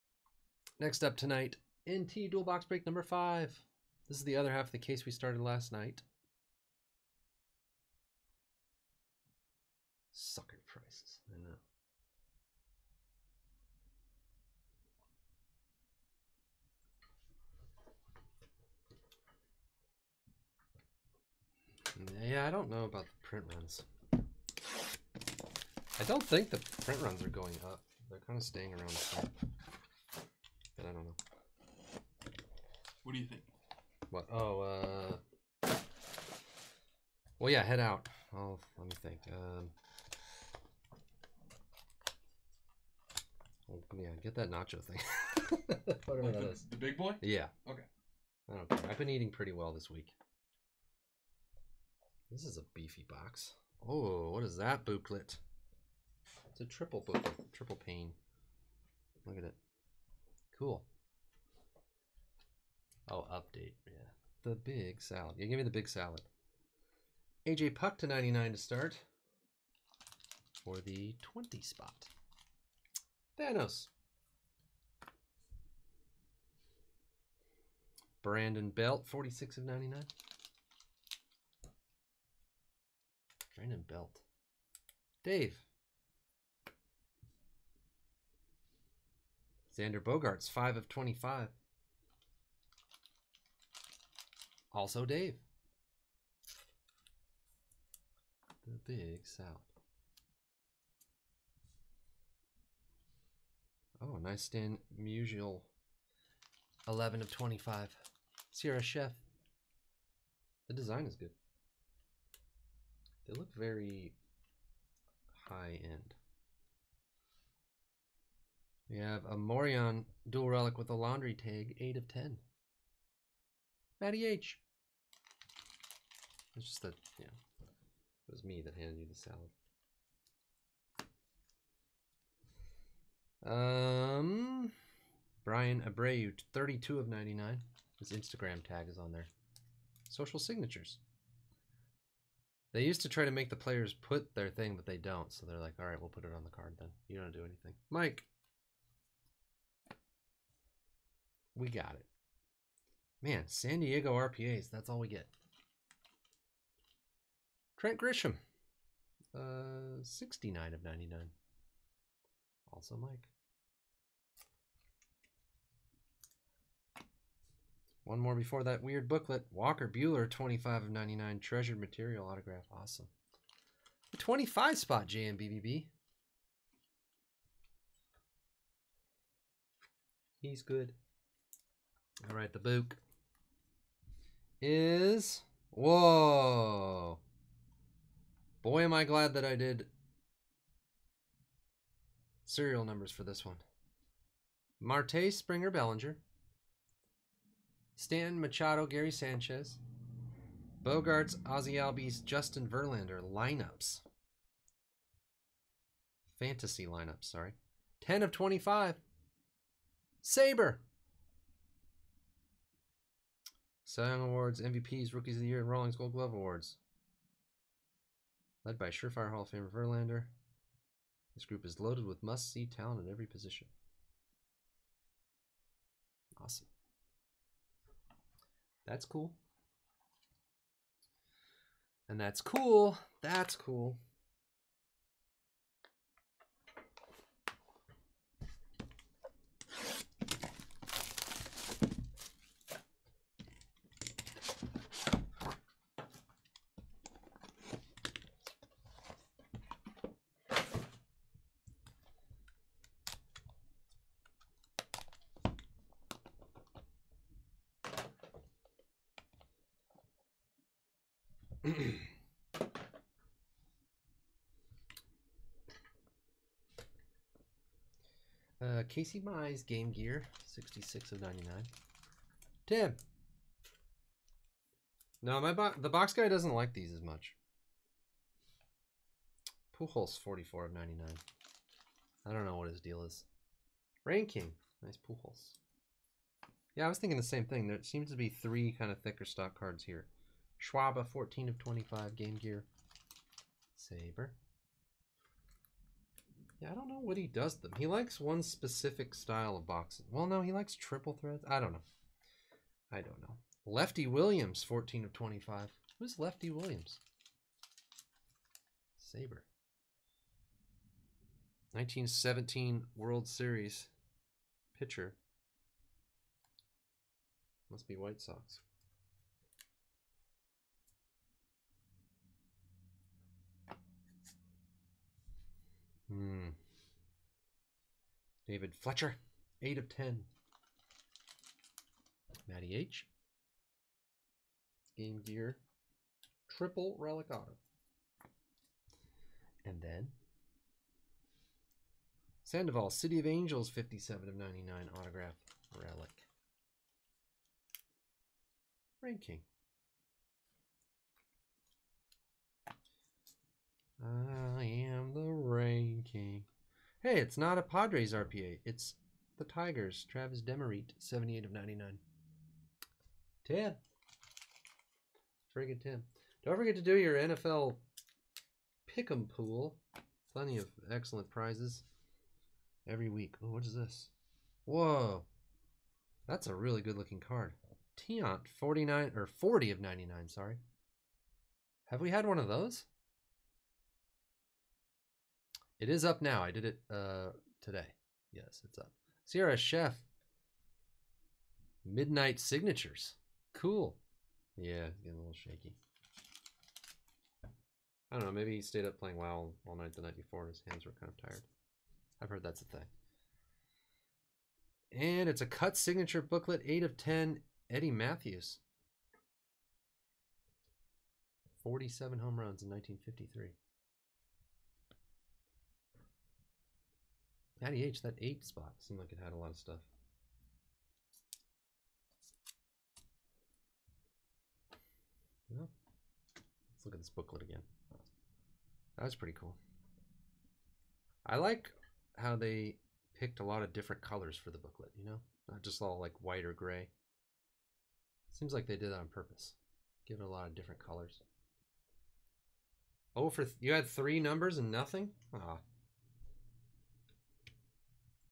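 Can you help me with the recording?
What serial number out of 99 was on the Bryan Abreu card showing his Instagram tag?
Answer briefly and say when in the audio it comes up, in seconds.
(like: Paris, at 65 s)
32, at 136 s.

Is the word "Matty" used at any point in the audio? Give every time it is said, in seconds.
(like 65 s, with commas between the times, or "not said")
124 s, 332 s.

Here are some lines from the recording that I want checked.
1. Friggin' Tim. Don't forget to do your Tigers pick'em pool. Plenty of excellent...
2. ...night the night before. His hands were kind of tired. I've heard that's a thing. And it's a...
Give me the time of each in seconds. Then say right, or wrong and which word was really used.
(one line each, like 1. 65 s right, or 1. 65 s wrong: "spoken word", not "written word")
1. 365 s wrong: "NFL", not "Tigers"
2. 399 s right.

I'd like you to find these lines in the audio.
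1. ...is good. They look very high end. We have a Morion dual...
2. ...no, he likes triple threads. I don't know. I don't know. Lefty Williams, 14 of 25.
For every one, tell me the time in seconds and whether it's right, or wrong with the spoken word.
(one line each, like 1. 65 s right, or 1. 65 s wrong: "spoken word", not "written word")
1. 111 s right
2. 300 s right.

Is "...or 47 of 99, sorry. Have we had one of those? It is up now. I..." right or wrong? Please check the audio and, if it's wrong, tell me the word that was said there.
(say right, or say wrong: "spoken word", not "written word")
wrong: "40", not "47".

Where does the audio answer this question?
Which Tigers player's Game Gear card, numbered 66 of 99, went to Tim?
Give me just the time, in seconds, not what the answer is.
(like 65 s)
268 s.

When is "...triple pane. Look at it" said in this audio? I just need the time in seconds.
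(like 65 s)
57 s.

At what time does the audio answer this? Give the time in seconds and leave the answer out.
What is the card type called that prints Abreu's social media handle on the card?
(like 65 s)
140 s.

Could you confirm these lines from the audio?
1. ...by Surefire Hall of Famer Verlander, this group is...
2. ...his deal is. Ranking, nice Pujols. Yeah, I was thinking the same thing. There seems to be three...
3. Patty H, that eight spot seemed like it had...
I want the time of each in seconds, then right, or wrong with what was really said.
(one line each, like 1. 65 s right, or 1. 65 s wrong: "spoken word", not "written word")
1. 218 s right
2. 282 s right
3. 417 s right.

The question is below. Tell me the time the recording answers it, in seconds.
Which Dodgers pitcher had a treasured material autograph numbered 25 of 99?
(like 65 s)
169 s.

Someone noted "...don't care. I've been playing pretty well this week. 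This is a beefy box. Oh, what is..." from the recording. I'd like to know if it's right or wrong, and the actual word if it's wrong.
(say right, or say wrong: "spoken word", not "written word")
wrong: "eating", not "playing".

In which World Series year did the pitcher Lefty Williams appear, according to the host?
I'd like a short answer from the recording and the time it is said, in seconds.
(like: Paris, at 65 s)
1917, at 311 s.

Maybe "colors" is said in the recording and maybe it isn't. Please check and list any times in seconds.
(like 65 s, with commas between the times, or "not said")
434 s, 440 s.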